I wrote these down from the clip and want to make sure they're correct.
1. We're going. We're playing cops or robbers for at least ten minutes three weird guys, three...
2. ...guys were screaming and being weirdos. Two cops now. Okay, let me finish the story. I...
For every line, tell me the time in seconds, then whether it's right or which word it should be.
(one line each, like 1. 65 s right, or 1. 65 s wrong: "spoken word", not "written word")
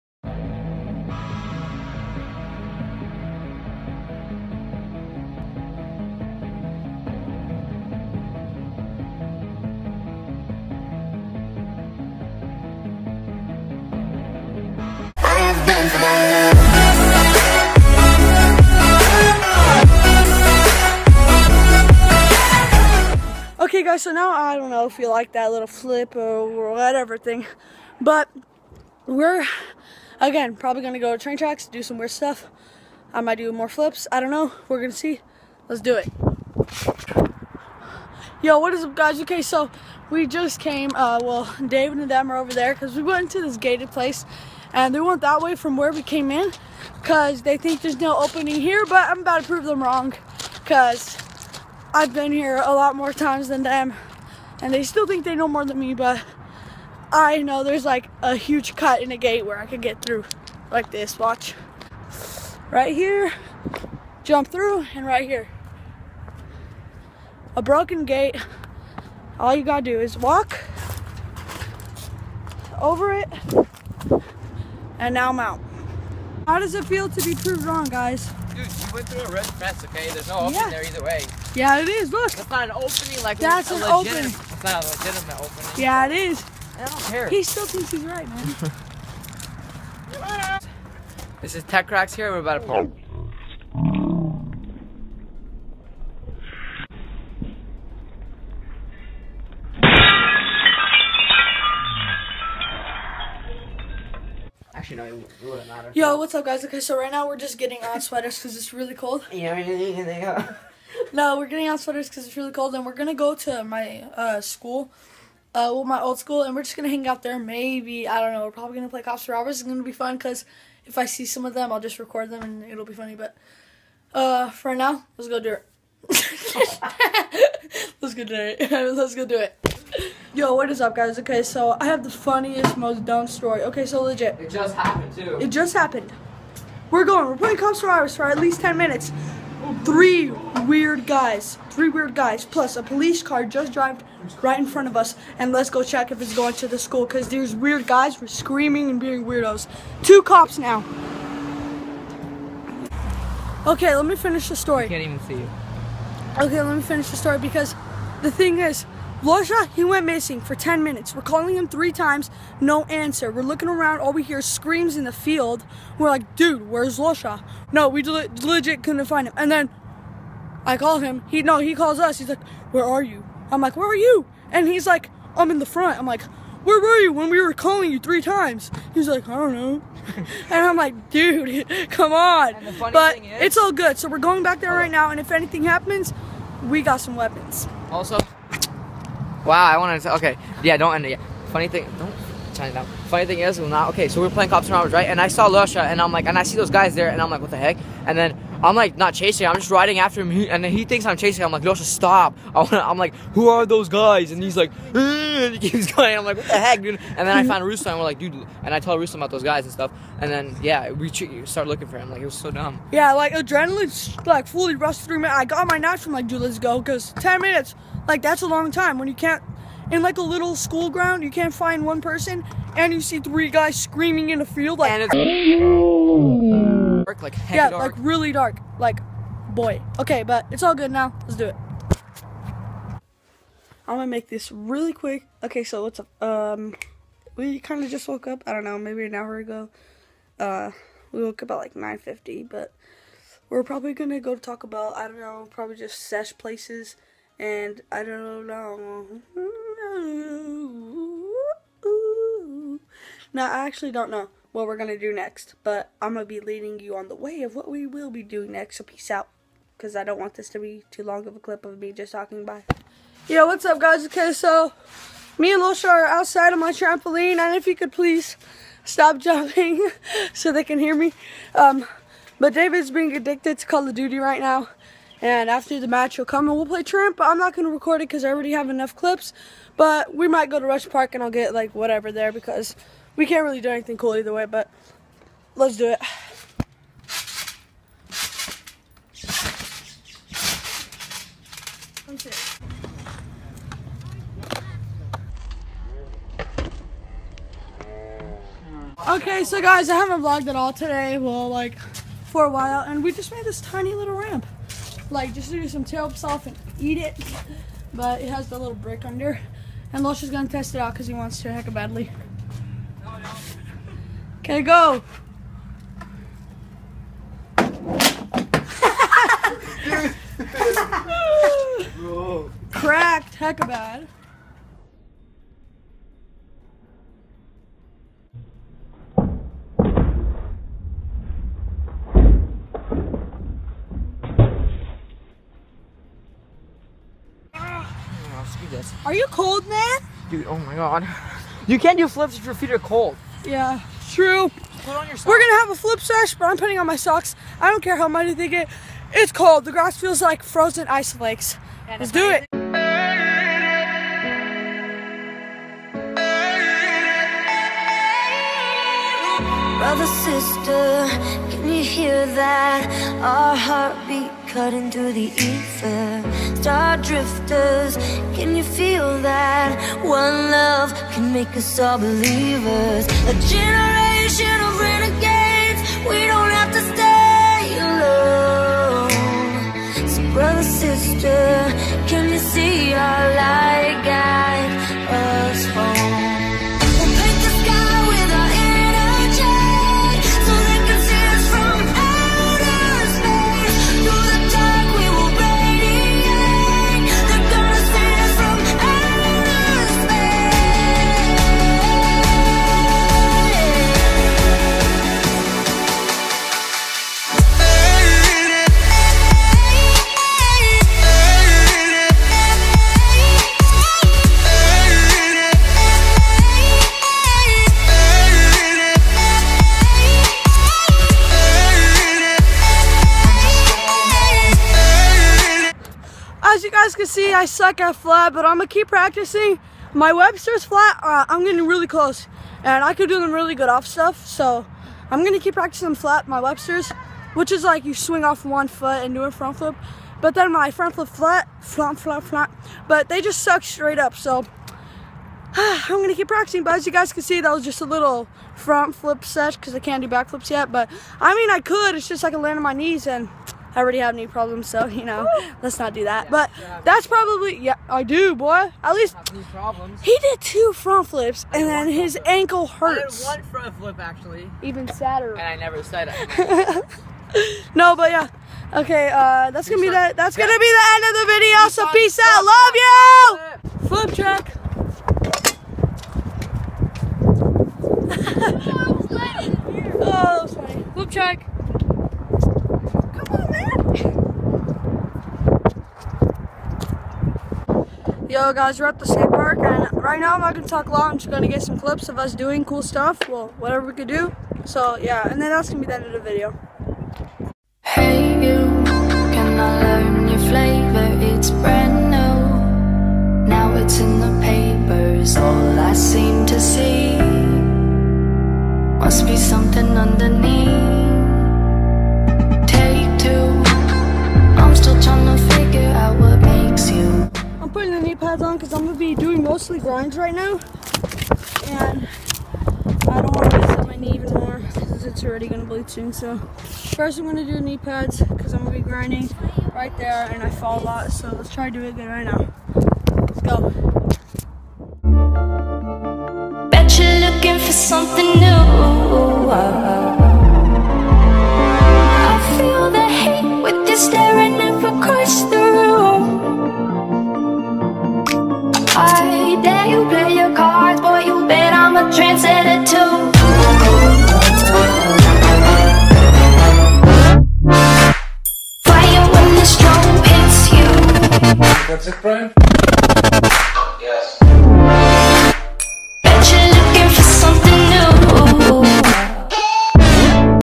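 1. 136 s right
2. 147 s right.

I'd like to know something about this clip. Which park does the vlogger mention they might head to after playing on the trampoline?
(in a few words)
Rush Park.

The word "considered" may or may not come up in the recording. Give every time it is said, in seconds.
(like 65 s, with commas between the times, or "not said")
not said.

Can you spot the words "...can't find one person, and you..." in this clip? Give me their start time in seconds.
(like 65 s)
221 s.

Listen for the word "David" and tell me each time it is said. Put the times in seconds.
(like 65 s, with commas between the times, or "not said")
41 s, 272 s.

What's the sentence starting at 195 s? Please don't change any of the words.
And I saw Lusha, and I'm like, and I see those guys there, and I'm like, what the heck?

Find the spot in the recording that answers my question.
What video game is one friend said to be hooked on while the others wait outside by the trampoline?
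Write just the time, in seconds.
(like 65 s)
273 s.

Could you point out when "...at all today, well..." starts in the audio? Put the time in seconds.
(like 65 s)
300 s.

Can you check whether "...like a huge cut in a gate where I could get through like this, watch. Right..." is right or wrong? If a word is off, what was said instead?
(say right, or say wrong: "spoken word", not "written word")
right.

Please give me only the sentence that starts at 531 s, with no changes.
So let's try to do it again right now.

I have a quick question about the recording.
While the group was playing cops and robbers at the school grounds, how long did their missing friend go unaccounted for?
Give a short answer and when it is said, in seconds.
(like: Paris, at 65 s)
10 minutes, at 160 s.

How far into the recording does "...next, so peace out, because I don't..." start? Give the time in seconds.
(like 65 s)
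258 s.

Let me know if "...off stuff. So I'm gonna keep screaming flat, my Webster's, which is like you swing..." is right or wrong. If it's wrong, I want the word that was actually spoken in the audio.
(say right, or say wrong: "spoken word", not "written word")
wrong: "practicing", not "screaming".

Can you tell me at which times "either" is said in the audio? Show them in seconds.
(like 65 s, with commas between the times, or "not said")
80 s, 284 s.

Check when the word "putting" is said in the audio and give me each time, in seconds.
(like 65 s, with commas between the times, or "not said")
346 s, 517 s.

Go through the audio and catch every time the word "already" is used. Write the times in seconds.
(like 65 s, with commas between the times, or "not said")
278 s, 453 s, 525 s.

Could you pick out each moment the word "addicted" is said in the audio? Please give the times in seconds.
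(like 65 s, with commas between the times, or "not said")
273 s.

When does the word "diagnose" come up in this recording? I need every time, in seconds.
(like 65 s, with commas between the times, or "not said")
not said.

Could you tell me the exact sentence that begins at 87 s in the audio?
He still thinks he's right, man.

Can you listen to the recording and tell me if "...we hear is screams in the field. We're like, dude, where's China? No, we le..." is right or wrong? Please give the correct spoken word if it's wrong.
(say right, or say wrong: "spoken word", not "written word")
wrong: "Lusha", not "China".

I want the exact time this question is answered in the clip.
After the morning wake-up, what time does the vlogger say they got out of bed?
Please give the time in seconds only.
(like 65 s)
241 s.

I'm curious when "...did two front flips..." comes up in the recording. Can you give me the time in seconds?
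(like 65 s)
460 s.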